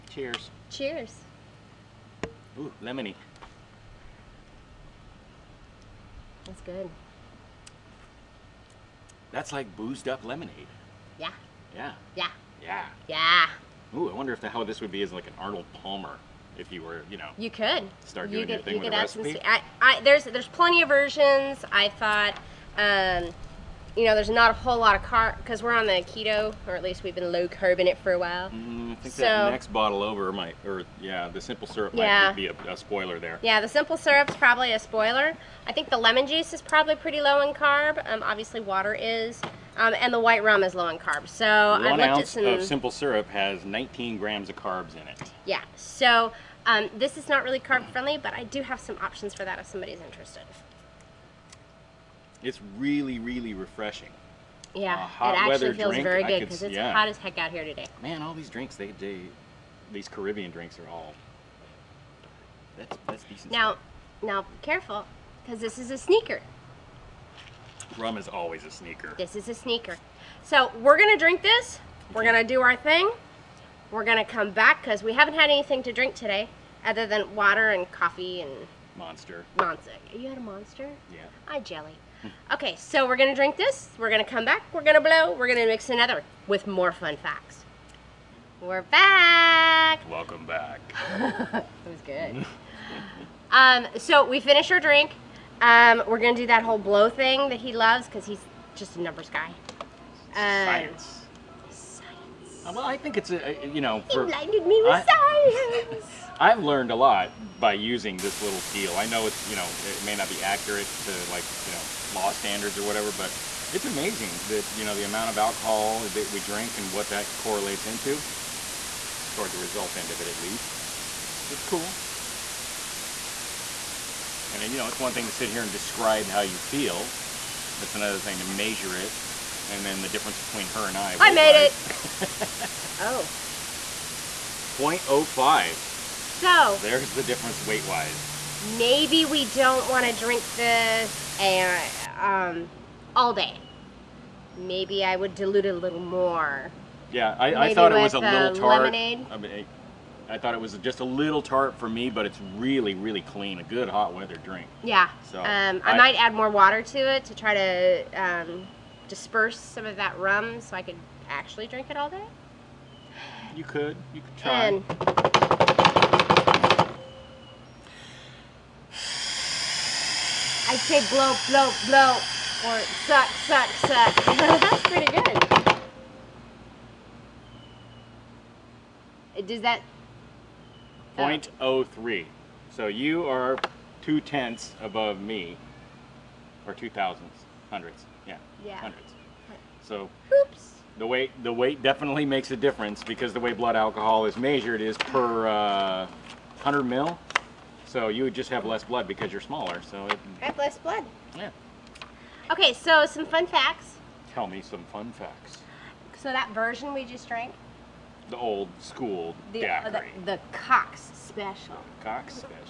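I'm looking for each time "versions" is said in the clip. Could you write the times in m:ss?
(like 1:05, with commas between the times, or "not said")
0:20, 3:26.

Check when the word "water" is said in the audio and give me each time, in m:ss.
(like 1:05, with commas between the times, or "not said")
0:38, 1:17, 2:36.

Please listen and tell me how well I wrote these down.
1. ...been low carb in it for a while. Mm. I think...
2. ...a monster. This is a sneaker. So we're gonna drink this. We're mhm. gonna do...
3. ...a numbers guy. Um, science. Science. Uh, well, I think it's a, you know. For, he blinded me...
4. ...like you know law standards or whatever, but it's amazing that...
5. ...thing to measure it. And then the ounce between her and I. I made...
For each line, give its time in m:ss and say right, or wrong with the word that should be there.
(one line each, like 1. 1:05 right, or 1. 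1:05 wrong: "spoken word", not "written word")
1. 0:27 right
2. 1:08 wrong: "sneaker", not "monster"
3. 1:38 right
4. 1:51 right
5. 2:08 wrong: "difference", not "ounce".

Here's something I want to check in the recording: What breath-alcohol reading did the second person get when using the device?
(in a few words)
0.03.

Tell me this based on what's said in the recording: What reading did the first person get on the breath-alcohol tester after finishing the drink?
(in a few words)
0.05.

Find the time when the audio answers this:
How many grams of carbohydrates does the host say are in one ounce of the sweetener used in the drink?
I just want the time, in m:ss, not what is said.
0:43.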